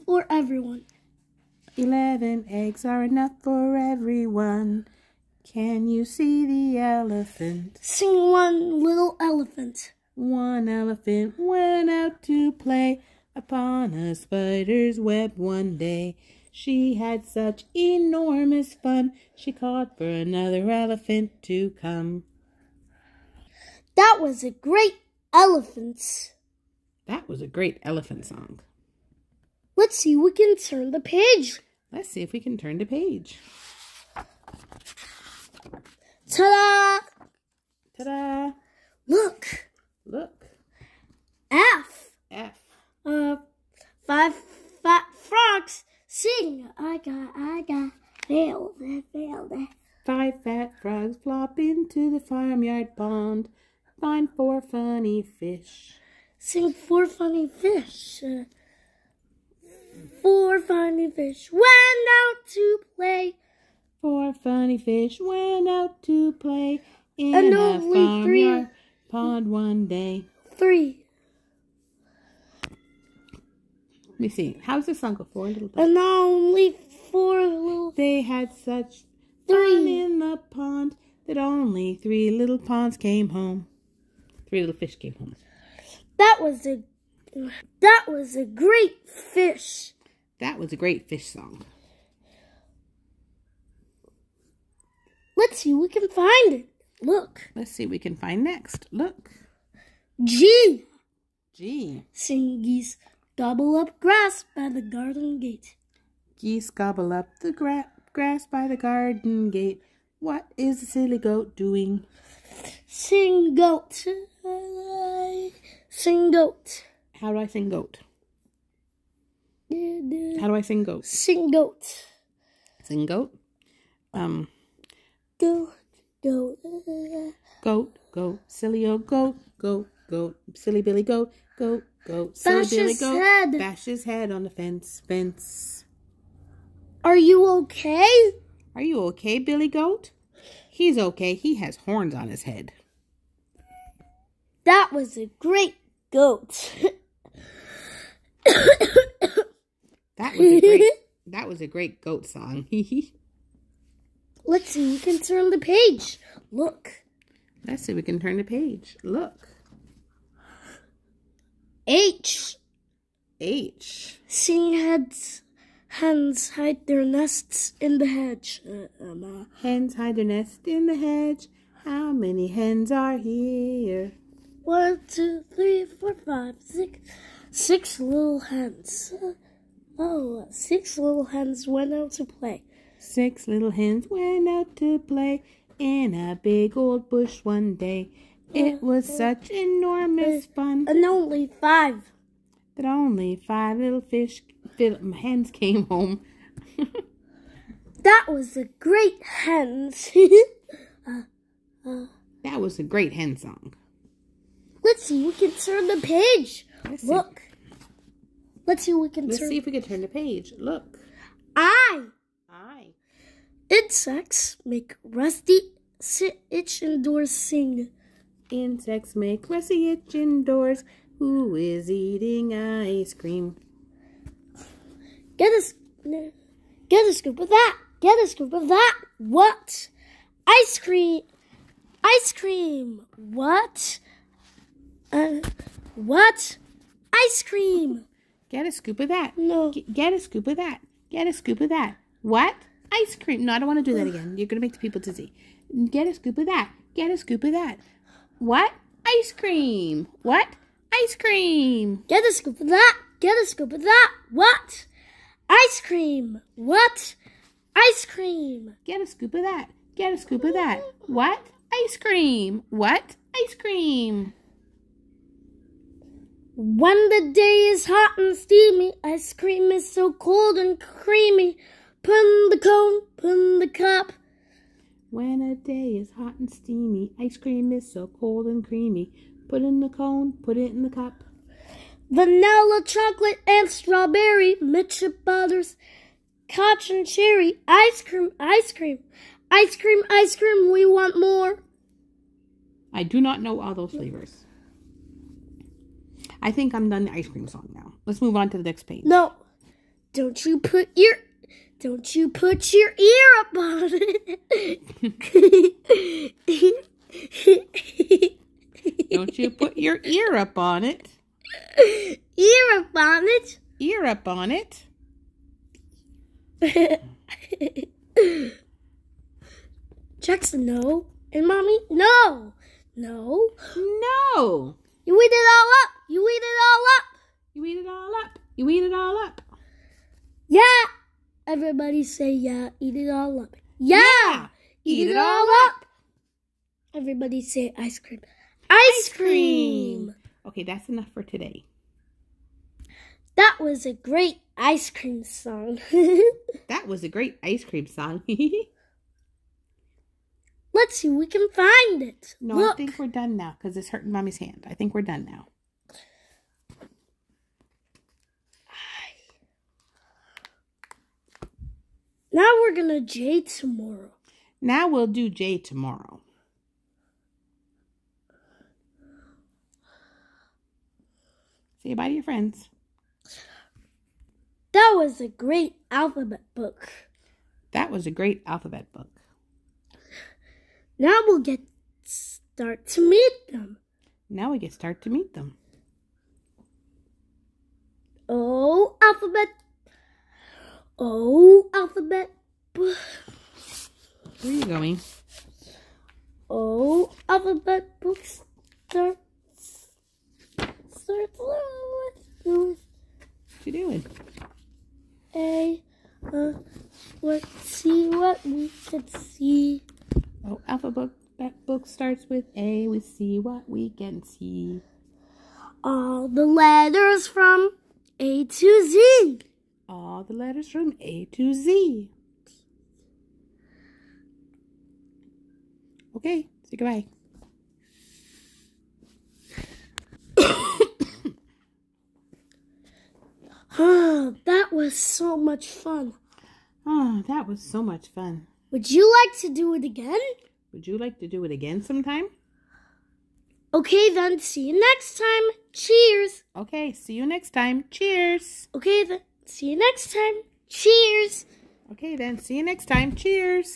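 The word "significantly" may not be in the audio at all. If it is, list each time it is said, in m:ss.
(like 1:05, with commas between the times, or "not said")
not said.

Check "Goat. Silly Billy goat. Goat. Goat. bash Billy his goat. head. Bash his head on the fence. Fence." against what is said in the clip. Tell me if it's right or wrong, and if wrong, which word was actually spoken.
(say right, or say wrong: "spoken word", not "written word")
right.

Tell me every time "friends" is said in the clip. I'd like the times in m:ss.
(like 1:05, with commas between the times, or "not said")
6:12.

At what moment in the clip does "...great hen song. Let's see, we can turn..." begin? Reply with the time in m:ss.
3:22.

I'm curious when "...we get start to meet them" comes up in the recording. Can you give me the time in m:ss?
6:24.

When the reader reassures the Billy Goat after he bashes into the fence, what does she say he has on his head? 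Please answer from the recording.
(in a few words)
Horns.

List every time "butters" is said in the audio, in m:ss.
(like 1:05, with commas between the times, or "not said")
4:45.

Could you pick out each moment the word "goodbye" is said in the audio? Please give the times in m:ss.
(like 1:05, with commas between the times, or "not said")
7:06.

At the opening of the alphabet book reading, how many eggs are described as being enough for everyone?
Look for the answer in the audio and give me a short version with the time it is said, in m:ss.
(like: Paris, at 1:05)
11, at 0:01.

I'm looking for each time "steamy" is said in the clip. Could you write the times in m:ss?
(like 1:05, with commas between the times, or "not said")
4:28, 4:36.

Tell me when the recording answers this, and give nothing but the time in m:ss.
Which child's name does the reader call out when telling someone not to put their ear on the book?
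5:20.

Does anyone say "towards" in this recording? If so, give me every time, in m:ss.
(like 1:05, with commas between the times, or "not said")
not said.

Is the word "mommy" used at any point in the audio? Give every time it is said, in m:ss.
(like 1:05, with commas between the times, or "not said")
5:21, 5:54.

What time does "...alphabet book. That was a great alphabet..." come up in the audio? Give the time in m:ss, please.
6:15.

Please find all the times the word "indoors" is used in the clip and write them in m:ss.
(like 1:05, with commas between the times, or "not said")
3:40.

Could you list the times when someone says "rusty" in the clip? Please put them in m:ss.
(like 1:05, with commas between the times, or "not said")
3:35, 3:39.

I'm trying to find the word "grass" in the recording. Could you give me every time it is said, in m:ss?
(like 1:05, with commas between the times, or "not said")
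1:43, 1:48.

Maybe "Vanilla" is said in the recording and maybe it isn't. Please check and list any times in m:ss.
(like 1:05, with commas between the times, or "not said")
4:42.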